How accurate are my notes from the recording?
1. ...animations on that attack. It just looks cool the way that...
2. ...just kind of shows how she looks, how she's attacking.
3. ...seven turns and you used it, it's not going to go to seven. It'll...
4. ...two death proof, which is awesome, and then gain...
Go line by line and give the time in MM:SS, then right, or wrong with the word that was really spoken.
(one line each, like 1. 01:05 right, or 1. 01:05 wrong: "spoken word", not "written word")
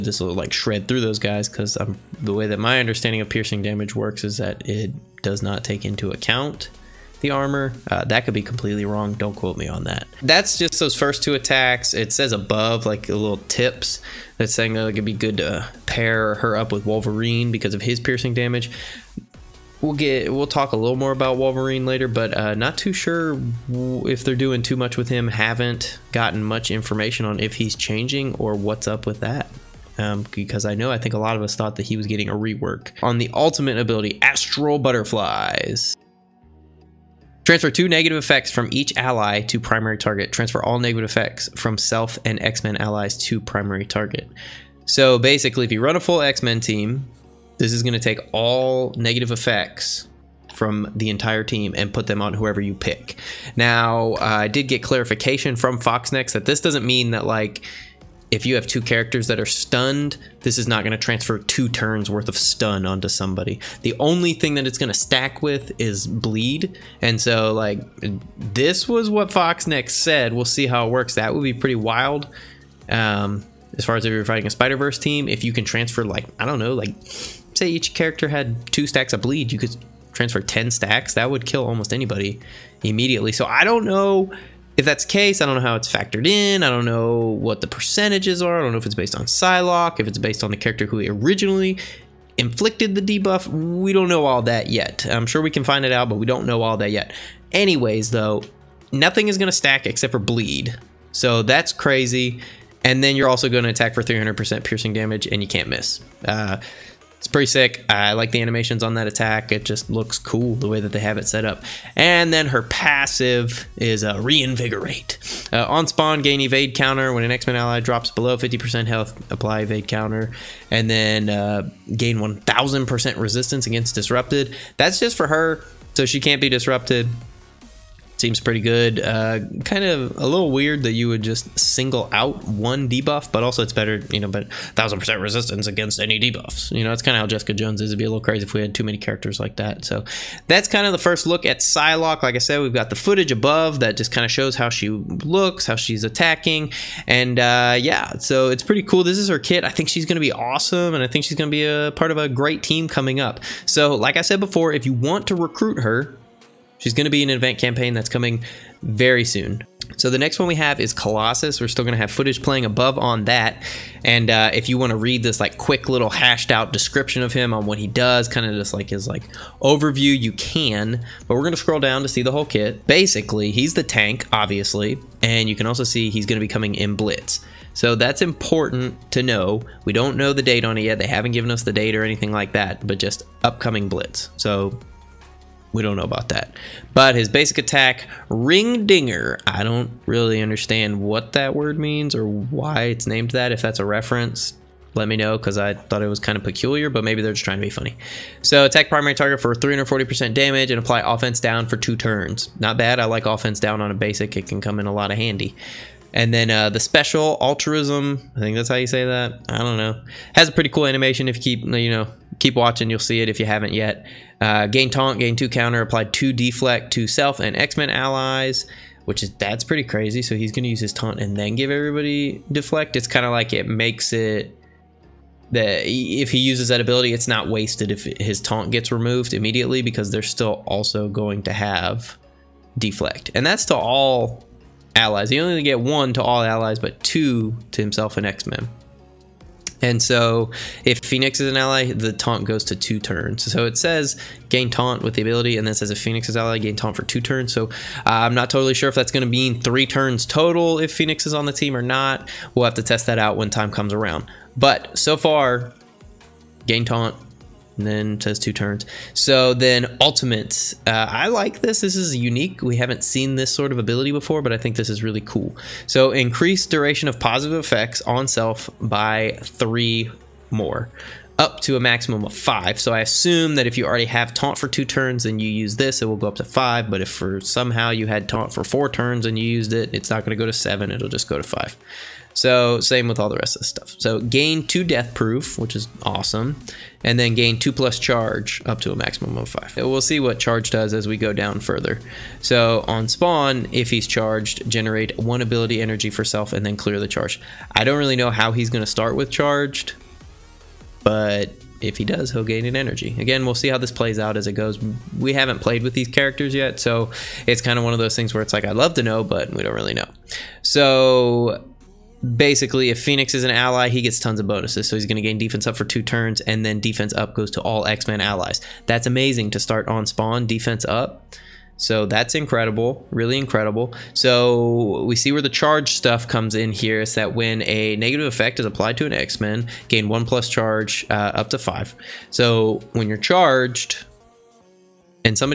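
1. 01:48 right
2. 02:23 right
3. 04:38 wrong: "four", not "seven"
4. 04:44 right.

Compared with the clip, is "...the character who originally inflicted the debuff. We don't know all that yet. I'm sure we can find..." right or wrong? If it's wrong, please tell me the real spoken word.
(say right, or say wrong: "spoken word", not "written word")
right.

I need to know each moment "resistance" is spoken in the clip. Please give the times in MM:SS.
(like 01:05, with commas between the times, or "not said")
02:03, 02:15.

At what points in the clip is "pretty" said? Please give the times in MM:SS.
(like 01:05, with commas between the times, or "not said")
01:11, 01:47, 02:08, 02:28, 03:30, 03:39.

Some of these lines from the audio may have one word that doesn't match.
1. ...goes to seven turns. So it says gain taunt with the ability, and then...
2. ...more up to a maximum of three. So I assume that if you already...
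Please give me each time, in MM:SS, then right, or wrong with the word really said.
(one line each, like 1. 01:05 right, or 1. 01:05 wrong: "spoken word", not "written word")
1. 04:02 wrong: "two", not "seven"
2. 04:30 wrong: "five", not "three".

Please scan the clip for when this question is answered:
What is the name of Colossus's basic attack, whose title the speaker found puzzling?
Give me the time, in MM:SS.
03:08.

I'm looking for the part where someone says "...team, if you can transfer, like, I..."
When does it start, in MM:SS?
01:14.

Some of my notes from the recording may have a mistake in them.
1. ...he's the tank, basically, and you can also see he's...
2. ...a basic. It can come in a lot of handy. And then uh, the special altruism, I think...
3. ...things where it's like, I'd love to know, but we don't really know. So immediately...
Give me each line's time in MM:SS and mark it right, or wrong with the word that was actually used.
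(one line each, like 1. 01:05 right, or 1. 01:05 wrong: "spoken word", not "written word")
1. 02:53 wrong: "obviously", not "basically"
2. 03:23 right
3. 05:08 wrong: "basically", not "immediately".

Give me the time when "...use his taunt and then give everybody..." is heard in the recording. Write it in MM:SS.
03:40.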